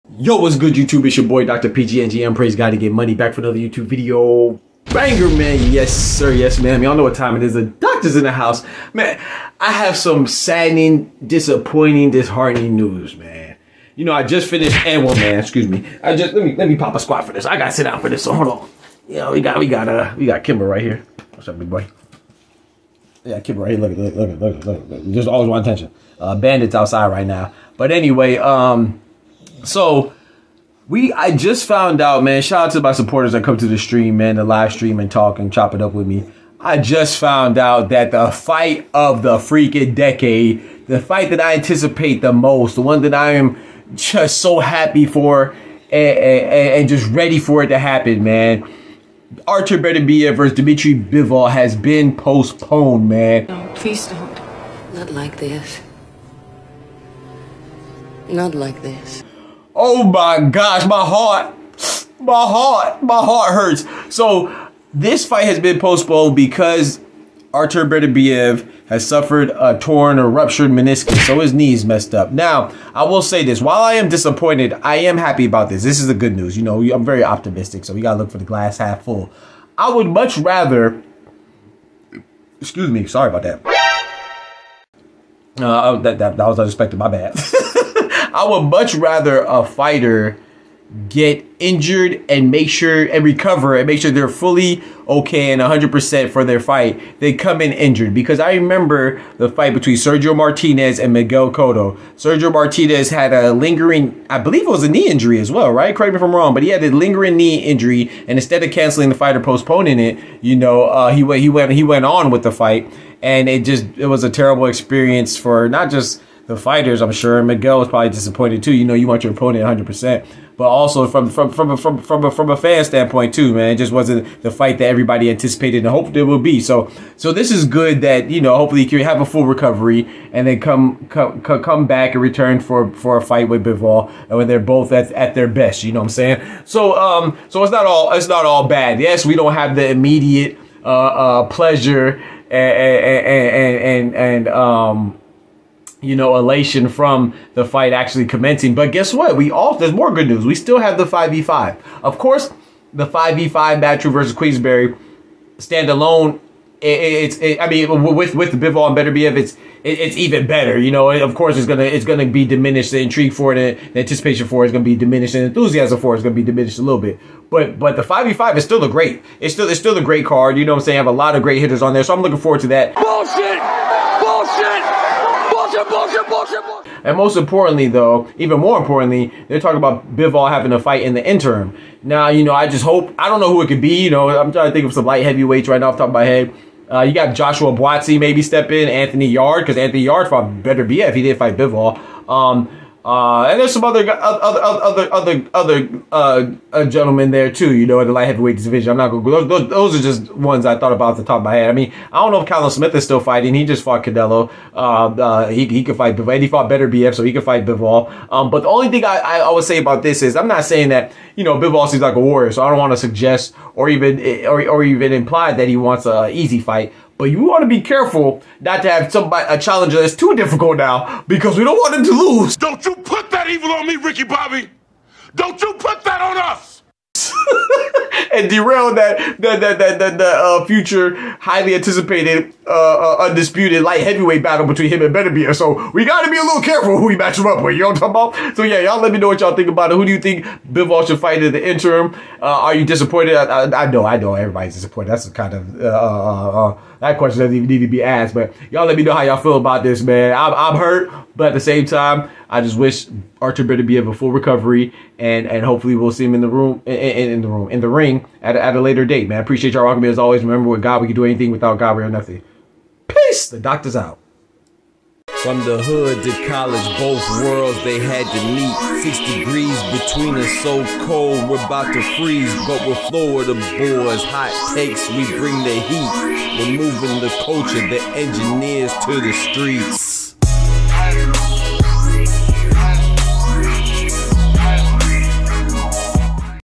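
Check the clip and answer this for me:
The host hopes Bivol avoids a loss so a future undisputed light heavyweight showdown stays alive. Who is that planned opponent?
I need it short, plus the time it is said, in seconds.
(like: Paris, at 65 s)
Benavidez, at 235 s.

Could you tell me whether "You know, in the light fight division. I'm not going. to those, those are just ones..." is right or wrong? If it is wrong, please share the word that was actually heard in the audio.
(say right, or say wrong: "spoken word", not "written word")
wrong: "heavyweight", not "fight".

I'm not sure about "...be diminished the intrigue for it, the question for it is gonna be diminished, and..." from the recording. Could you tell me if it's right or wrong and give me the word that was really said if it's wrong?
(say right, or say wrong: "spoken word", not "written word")
wrong: "anticipation", not "question".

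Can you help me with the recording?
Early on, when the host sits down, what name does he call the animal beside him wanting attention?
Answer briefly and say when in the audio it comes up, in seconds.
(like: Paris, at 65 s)
Kimber, at 20 s.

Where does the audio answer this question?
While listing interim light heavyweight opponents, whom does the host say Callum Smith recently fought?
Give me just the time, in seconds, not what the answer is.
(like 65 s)
204 s.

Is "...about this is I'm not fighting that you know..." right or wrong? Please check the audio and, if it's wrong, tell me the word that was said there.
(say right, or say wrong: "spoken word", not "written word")
wrong: "saying", not "fighting".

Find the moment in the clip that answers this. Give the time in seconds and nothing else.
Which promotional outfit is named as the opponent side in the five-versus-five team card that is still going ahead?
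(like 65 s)
154 s.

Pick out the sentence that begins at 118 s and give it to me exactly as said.
You know, you want your opponent 100, percent but also from from from from from a, from a fan standpoint too, man.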